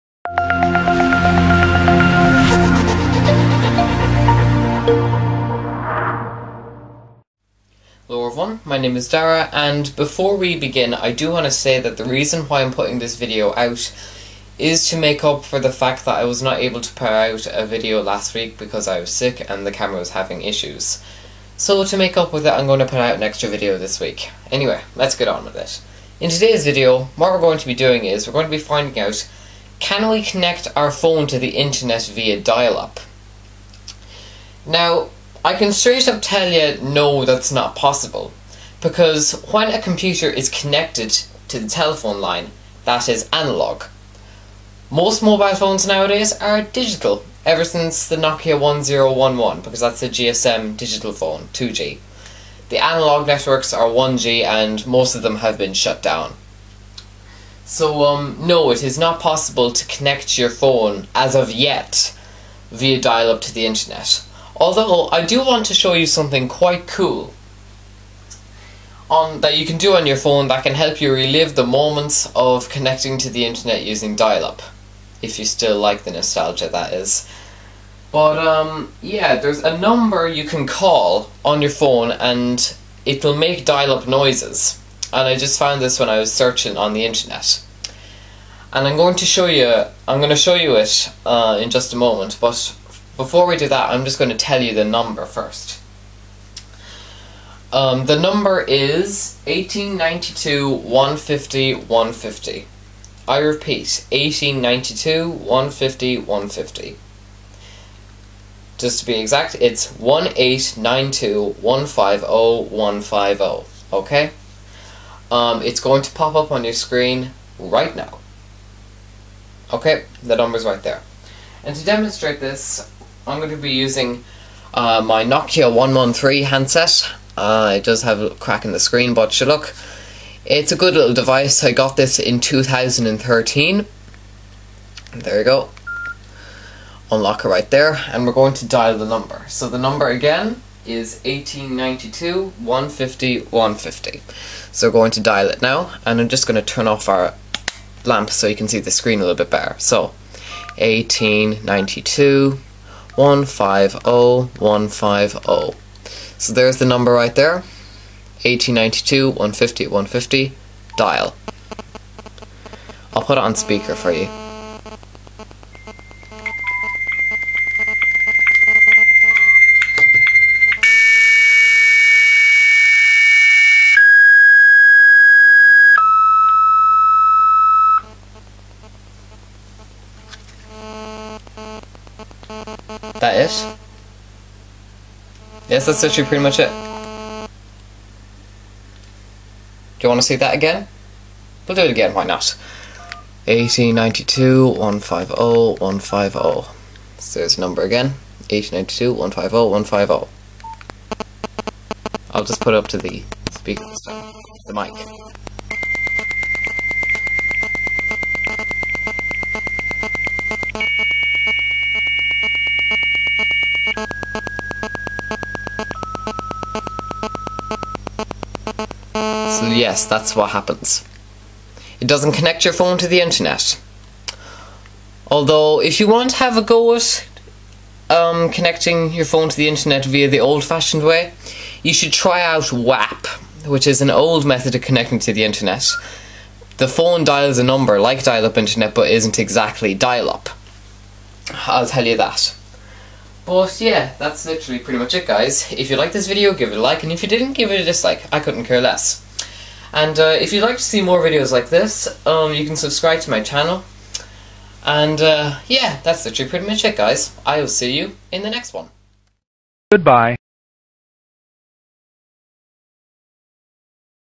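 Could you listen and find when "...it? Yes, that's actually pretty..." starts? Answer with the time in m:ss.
3:03.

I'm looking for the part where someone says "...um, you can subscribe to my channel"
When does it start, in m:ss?
4:12.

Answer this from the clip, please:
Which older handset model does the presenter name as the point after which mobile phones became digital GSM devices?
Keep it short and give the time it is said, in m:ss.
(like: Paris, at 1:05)
Nokia 1011, at 0:48.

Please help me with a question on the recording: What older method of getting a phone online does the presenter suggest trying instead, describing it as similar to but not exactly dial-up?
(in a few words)
WAP.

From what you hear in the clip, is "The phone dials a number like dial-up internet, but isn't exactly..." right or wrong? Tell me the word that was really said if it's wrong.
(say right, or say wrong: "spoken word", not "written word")
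right.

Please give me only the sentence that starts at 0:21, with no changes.
So to make up with it, I'm going to put out an extra video this week.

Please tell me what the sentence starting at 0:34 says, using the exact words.
Now, I can straight up tell you no, that's not possible.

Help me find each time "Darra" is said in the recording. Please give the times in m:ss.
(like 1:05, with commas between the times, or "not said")
0:09.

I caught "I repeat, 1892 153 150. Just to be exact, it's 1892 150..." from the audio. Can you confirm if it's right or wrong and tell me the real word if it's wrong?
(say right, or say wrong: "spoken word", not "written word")
wrong: "150", not "153".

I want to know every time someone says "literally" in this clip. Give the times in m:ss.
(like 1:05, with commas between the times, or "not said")
4:04, 4:16.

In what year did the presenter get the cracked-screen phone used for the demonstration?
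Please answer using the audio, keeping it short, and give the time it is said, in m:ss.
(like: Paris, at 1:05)
2013, at 2:12.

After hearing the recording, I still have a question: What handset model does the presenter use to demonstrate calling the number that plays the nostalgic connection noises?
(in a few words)
Nokia 113.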